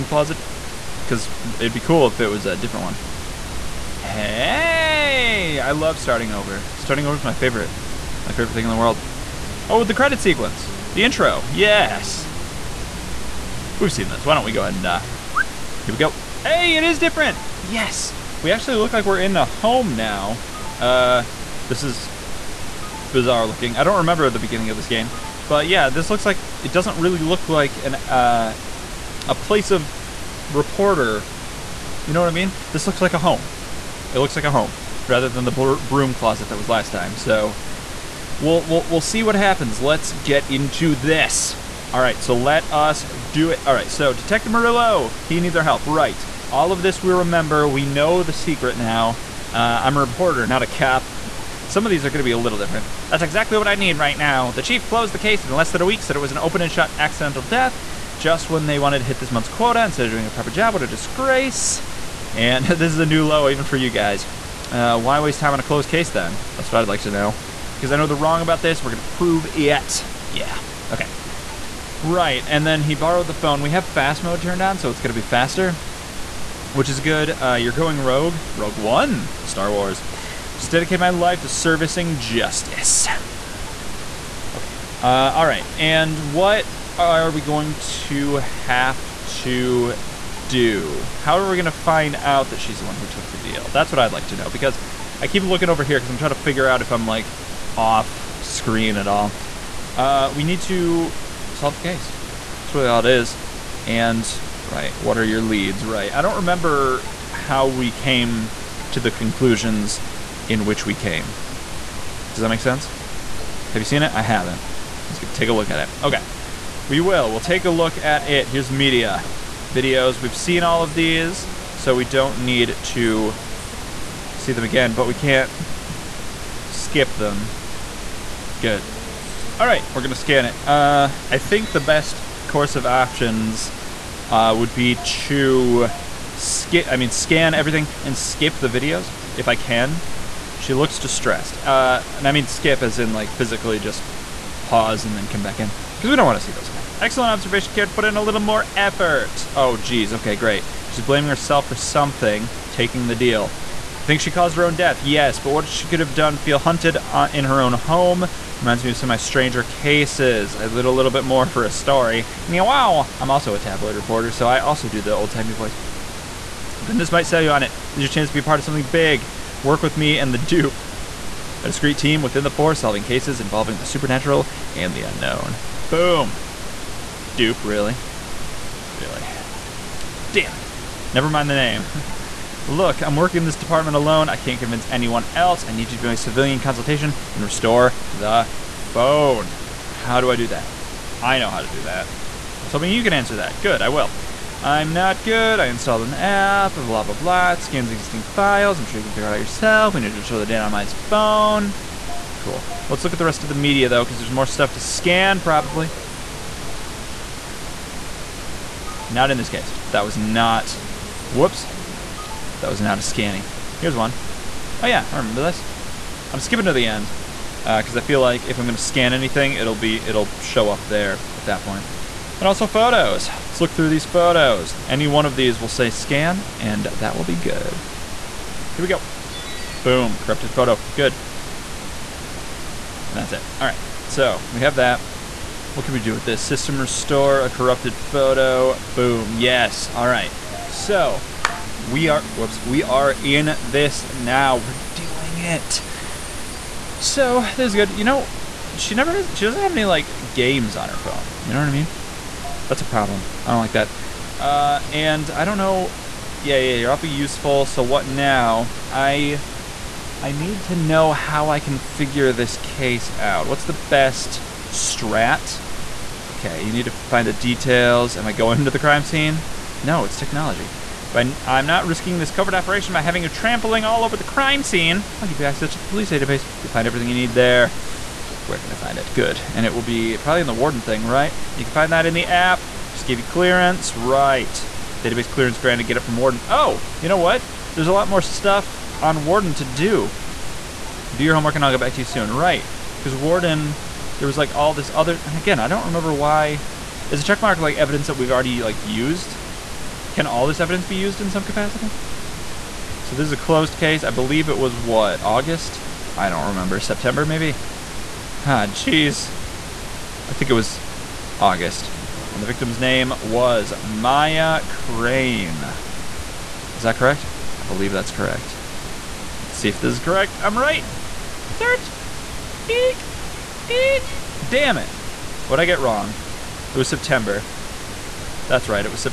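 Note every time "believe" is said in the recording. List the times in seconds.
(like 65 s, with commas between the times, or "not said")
304 s, 317 s.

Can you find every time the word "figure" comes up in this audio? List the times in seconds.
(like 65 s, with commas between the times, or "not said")
96 s, 199 s, 261 s.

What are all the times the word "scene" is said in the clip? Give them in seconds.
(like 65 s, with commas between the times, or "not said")
269 s, 274 s.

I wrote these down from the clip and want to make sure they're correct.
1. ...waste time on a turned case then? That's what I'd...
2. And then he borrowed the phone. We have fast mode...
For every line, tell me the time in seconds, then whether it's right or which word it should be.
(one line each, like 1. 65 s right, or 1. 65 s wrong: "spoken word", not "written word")
1. 65 s wrong: "closed", not "turned"
2. 72 s right.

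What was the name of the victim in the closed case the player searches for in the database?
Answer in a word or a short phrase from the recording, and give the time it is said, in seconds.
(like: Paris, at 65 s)
Maya Crane, at 313 s.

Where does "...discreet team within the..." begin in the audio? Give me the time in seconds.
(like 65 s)
171 s.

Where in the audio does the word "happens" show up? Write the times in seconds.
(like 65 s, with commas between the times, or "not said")
39 s.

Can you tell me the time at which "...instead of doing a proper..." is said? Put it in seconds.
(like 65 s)
59 s.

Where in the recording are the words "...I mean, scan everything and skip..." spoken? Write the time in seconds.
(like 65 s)
136 s.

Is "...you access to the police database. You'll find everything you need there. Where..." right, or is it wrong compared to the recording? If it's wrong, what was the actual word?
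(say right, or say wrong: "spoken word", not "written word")
right.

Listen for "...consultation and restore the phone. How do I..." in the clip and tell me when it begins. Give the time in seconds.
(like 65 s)
186 s.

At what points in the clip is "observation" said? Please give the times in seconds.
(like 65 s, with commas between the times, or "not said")
147 s.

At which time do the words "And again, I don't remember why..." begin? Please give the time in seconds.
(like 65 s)
295 s.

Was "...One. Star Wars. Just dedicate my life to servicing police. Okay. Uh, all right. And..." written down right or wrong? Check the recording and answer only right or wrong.
wrong.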